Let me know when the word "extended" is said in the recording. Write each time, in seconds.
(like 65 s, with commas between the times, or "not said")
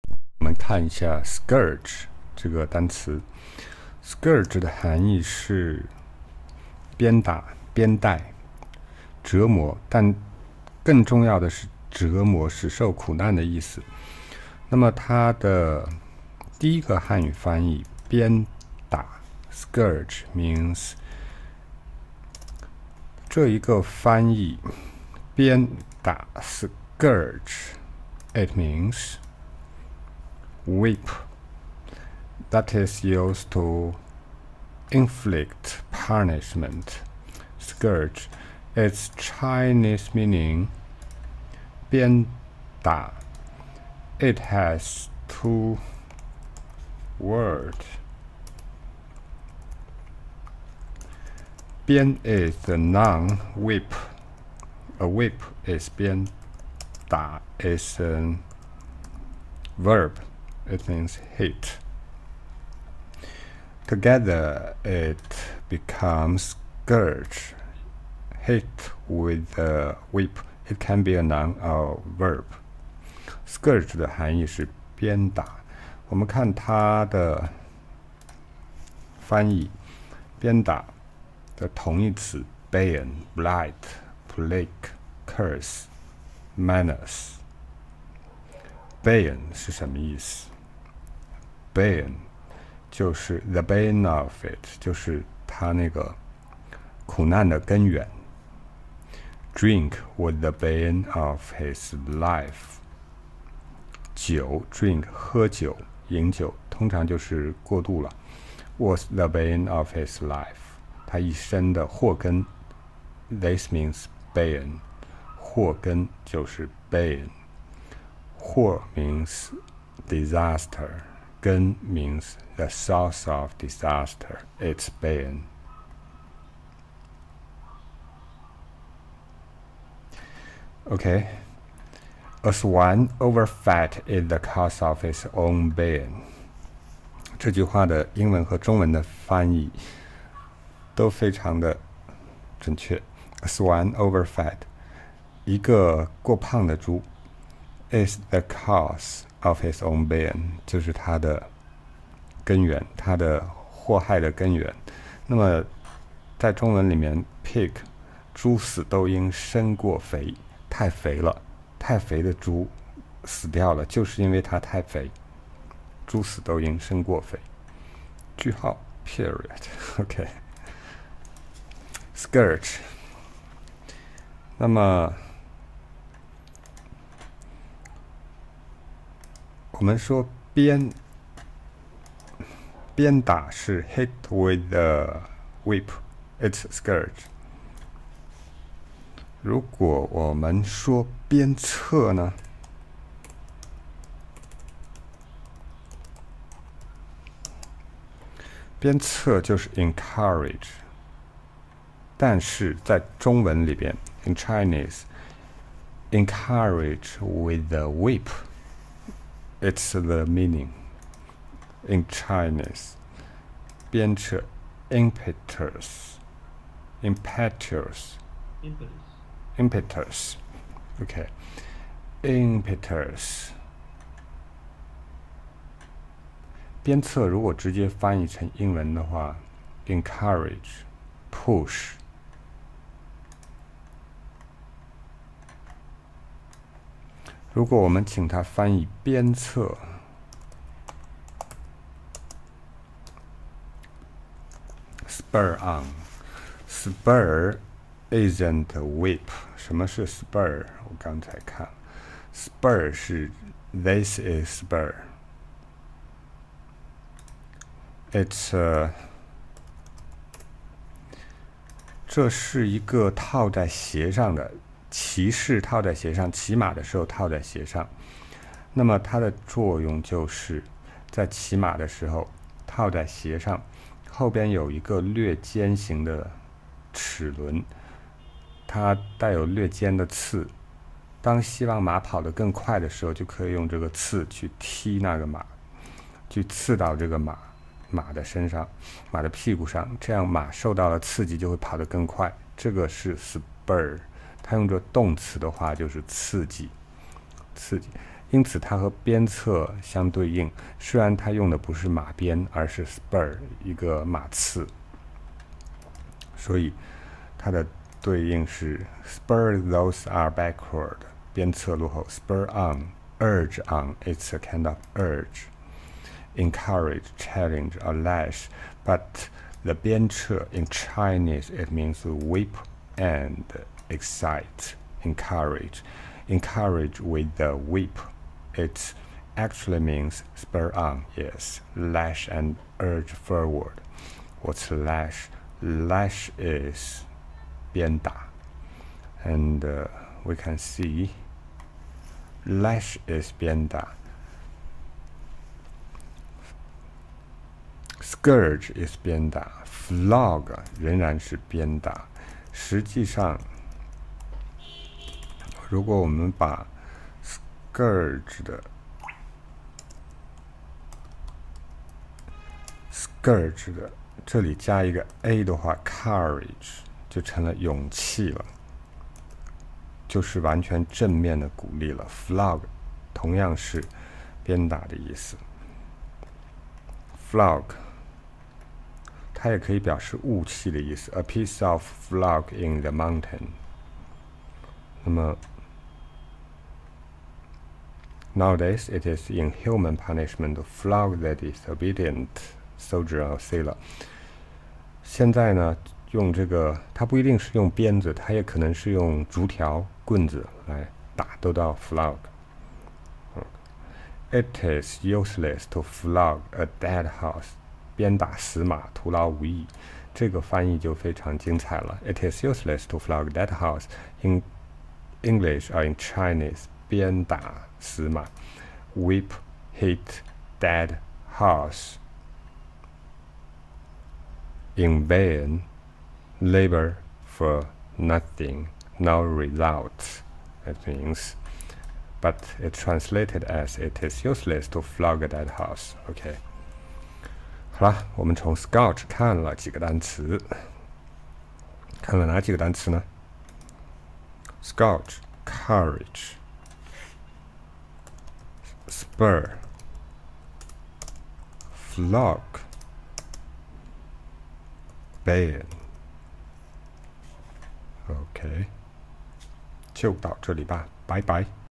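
not said.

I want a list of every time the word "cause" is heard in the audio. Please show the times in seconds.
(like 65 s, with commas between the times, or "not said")
134 s, 148 s.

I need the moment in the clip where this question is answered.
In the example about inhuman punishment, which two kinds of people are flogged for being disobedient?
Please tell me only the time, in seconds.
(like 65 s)
392 s.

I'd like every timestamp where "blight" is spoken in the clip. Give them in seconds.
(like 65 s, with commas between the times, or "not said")
83 s.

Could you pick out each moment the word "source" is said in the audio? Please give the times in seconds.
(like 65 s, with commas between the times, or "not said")
122 s.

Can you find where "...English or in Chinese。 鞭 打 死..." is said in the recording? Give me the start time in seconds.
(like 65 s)
415 s.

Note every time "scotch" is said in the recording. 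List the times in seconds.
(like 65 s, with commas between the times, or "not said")
438 s, 444 s.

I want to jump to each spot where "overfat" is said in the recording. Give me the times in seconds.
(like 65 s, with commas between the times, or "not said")
133 s, 143 s.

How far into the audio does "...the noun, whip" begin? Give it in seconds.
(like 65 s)
52 s.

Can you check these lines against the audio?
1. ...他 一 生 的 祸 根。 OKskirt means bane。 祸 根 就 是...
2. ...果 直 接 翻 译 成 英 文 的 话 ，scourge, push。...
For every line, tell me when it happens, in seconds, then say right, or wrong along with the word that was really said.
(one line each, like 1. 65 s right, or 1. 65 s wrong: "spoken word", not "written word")
1. 111 s wrong: "This", not "OKskirt"
2. 227 s wrong: "encourage", not "scourge".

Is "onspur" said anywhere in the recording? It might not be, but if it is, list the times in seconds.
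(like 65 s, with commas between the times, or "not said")
245 s.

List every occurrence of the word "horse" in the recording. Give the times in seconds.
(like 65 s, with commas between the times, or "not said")
407 s, 413 s, 421 s, 435 s.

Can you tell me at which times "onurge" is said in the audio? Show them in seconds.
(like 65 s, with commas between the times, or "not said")
312 s.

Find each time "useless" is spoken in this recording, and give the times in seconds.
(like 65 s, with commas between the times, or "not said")
405 s, 412 s, 434 s.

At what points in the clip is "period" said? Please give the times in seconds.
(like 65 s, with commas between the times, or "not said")
169 s.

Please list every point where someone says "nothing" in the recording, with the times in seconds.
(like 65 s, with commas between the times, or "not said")
427 s.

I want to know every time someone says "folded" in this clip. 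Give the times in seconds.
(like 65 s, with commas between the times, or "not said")
not said.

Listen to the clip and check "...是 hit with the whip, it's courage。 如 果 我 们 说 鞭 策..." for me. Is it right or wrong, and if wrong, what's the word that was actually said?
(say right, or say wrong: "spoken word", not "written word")
wrong: "scourge", not "courage".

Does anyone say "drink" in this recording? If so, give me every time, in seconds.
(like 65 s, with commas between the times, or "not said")
99 s, 104 s.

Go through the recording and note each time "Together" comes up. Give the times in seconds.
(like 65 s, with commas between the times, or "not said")
63 s.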